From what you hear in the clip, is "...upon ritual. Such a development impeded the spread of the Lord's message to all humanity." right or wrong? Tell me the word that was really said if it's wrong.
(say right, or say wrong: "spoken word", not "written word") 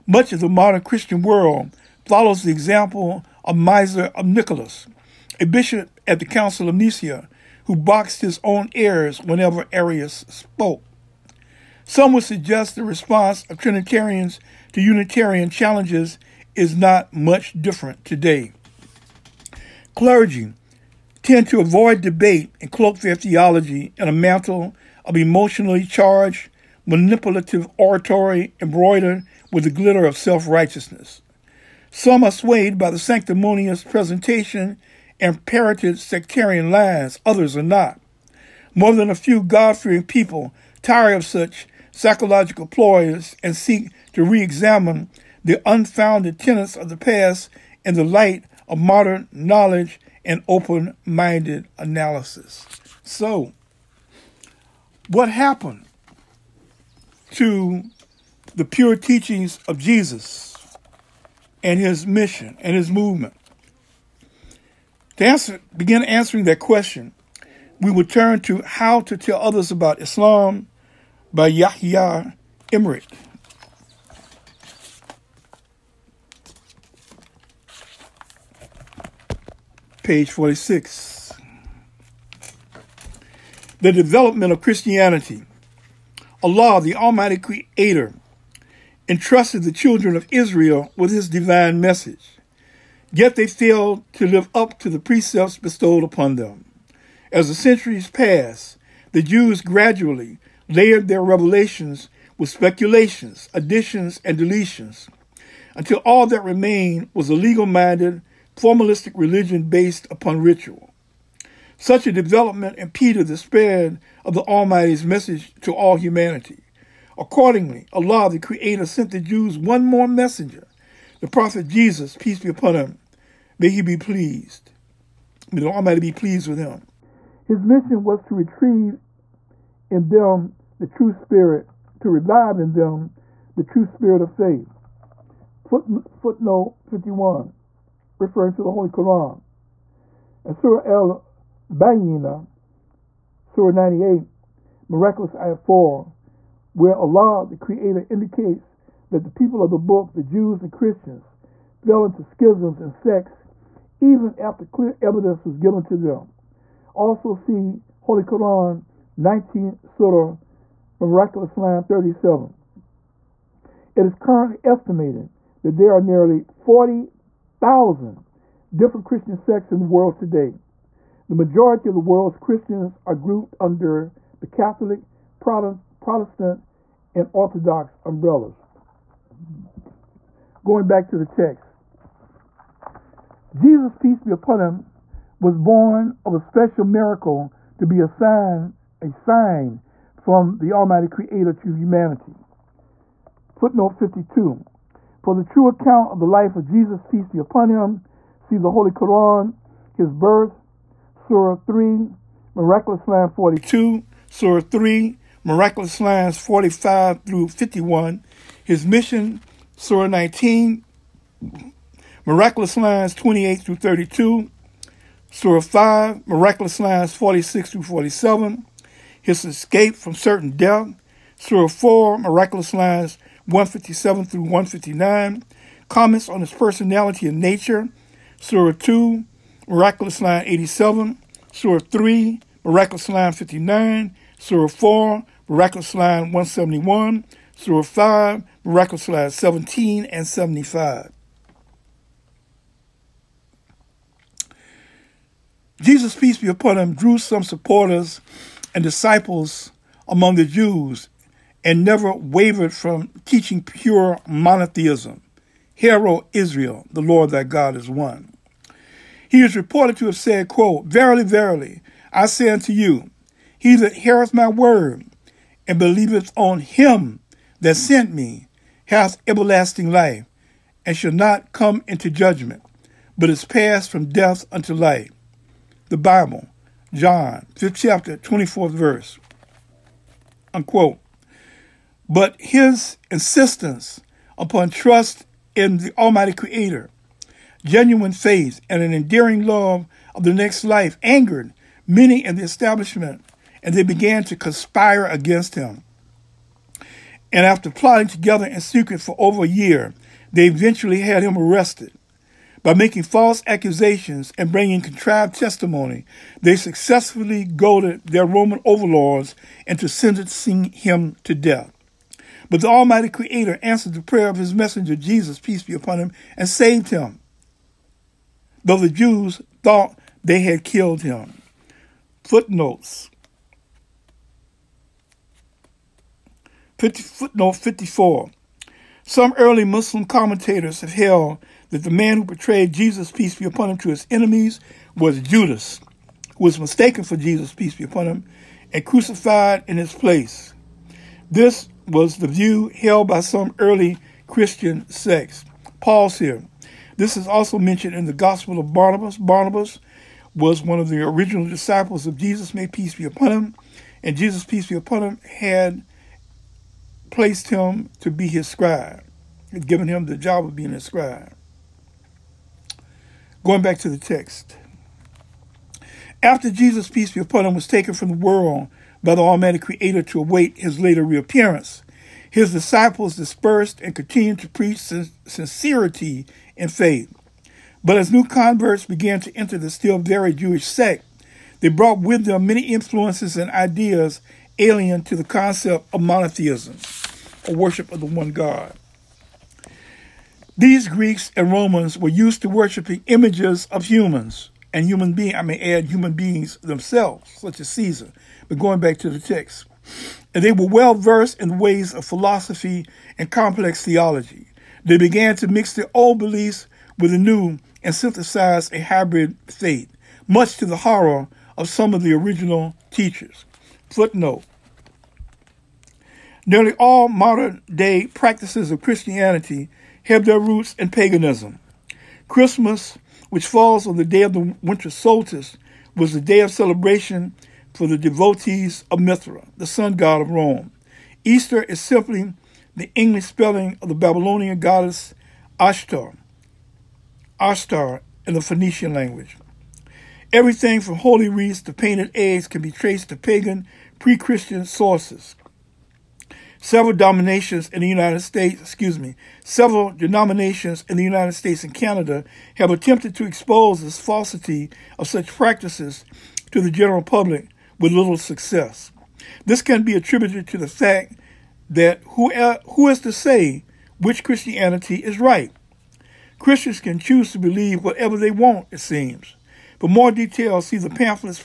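wrong: "Almighty", not "Lord".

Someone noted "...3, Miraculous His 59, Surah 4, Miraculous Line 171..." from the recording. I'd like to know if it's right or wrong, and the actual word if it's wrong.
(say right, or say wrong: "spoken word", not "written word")
wrong: "Line", not "His".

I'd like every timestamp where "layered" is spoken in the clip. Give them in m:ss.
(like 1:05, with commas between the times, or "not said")
1:40.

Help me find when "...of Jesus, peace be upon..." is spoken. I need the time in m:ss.
3:16.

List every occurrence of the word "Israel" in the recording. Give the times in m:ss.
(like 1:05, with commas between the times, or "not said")
1:30, 4:16.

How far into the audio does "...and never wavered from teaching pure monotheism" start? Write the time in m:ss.
4:11.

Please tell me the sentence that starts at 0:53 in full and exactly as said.
So, what happened to the pure teachings of Jesus and his mission and his movement?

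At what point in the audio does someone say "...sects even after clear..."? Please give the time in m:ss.
2:32.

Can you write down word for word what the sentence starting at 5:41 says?
This was the view held by some early Christian sects.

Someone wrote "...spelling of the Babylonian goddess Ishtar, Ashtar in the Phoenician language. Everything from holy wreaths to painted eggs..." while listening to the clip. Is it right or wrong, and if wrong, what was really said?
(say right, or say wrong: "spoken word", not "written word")
right.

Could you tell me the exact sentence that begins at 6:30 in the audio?
These Greeks and Romans were used to worshiping images of humans and human beings.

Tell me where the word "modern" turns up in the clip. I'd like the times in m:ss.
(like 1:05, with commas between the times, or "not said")
0:00, 0:48, 6:57.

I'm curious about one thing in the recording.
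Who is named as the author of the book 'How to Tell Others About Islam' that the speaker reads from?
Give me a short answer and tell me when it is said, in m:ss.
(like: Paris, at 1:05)
Yahya Emerick, at 1:11.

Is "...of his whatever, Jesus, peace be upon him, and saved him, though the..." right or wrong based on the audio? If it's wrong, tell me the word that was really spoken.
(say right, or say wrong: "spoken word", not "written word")
wrong: "messenger", not "whatever".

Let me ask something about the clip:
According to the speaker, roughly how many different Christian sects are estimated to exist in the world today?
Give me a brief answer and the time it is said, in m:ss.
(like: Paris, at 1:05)
40,000, at 2:46.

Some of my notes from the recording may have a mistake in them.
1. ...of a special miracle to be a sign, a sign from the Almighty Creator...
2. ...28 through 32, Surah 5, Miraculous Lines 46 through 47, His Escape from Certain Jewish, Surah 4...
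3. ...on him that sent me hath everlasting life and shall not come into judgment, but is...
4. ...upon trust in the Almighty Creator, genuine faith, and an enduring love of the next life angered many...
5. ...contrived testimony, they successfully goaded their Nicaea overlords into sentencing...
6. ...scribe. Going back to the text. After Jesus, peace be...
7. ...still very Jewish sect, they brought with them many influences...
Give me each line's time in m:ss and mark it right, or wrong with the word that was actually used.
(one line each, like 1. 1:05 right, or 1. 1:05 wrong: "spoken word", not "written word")
1. 3:06 right
2. 3:33 wrong: "Death", not "Jewish"
3. 4:26 right
4. 4:44 right
5. 5:04 wrong: "Roman", not "Nicaea"
6. 6:00 right
7. 6:19 right.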